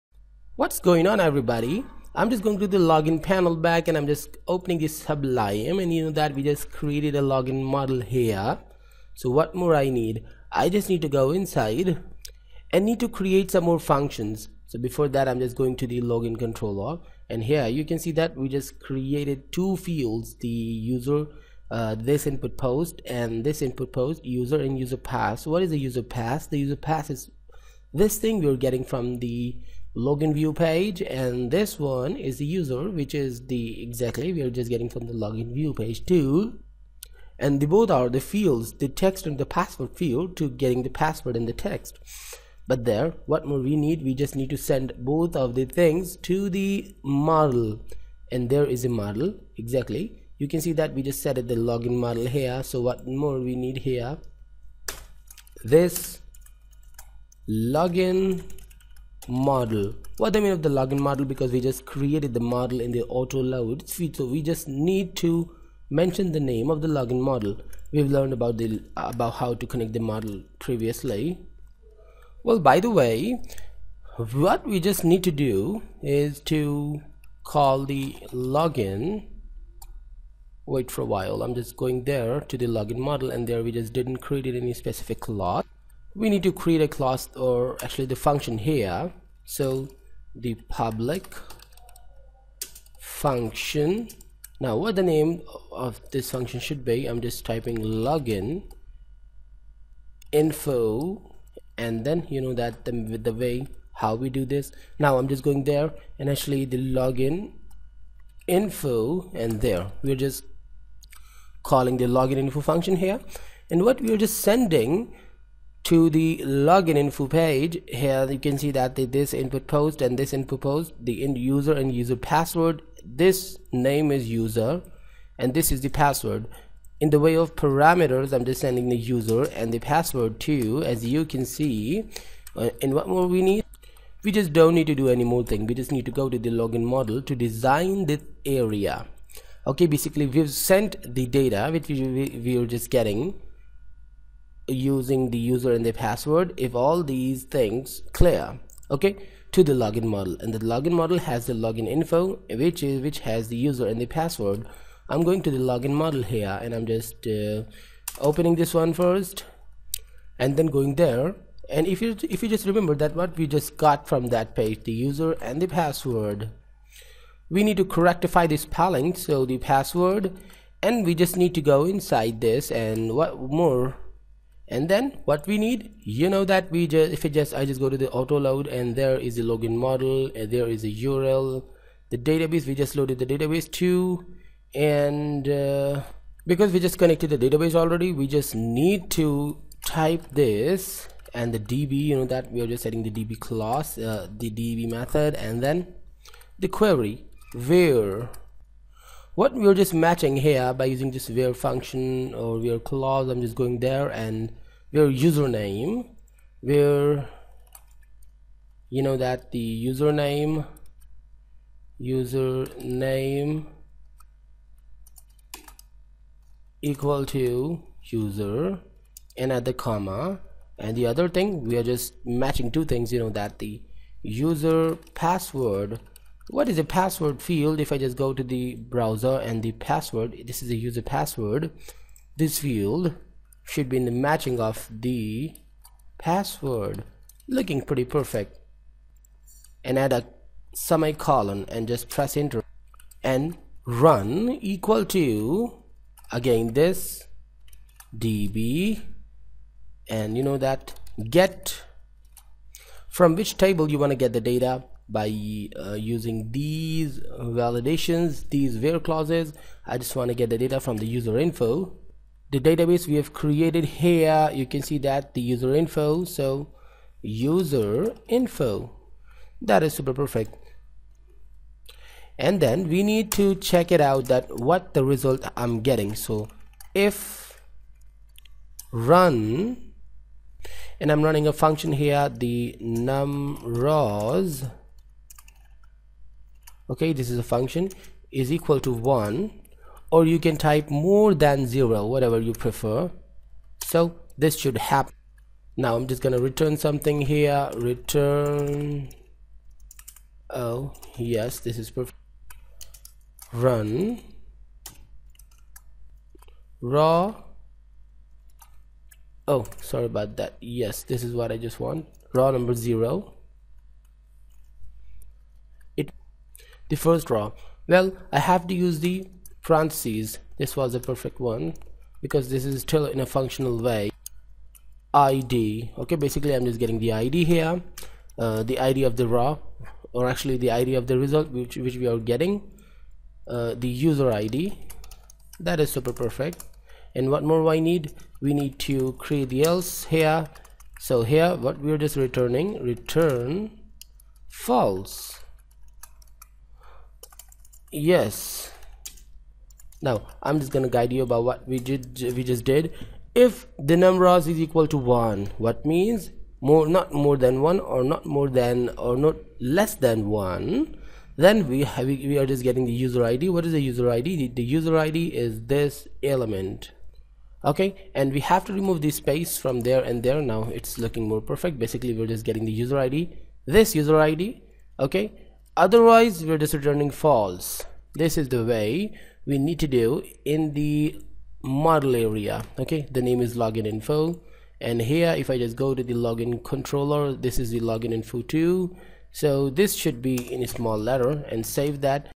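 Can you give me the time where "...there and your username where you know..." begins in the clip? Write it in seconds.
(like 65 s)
203 s.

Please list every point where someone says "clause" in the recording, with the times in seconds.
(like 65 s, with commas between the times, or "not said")
202 s, 258 s.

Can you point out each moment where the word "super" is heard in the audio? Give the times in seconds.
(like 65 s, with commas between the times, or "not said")
269 s, 335 s.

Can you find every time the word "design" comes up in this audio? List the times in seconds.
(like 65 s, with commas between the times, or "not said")
137 s.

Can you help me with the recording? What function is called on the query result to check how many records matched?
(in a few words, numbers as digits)
num rows.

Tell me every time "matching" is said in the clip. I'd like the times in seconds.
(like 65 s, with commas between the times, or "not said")
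199 s, 222 s, 234 s.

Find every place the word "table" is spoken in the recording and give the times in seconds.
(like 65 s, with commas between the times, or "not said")
253 s.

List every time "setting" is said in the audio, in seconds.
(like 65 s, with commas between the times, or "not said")
192 s.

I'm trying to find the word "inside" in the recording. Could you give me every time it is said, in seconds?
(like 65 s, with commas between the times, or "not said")
11 s, 171 s.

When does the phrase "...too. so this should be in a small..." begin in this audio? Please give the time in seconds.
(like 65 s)
388 s.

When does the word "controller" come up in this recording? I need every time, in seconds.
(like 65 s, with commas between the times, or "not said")
16 s, 386 s.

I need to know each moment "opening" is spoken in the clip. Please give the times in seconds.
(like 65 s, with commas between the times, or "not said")
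4 s, 158 s.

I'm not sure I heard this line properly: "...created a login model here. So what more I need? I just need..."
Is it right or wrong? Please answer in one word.
right.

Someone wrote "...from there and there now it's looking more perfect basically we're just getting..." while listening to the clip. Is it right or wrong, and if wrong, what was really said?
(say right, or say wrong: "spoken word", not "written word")
right.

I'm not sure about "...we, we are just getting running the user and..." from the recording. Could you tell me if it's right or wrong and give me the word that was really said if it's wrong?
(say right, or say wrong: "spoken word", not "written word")
wrong: "using", not "running".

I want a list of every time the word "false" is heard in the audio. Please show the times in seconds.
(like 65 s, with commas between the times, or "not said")
344 s, 377 s.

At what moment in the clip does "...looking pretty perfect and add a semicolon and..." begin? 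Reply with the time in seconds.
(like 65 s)
237 s.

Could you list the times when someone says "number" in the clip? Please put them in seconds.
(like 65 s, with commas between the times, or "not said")
312 s, 353 s.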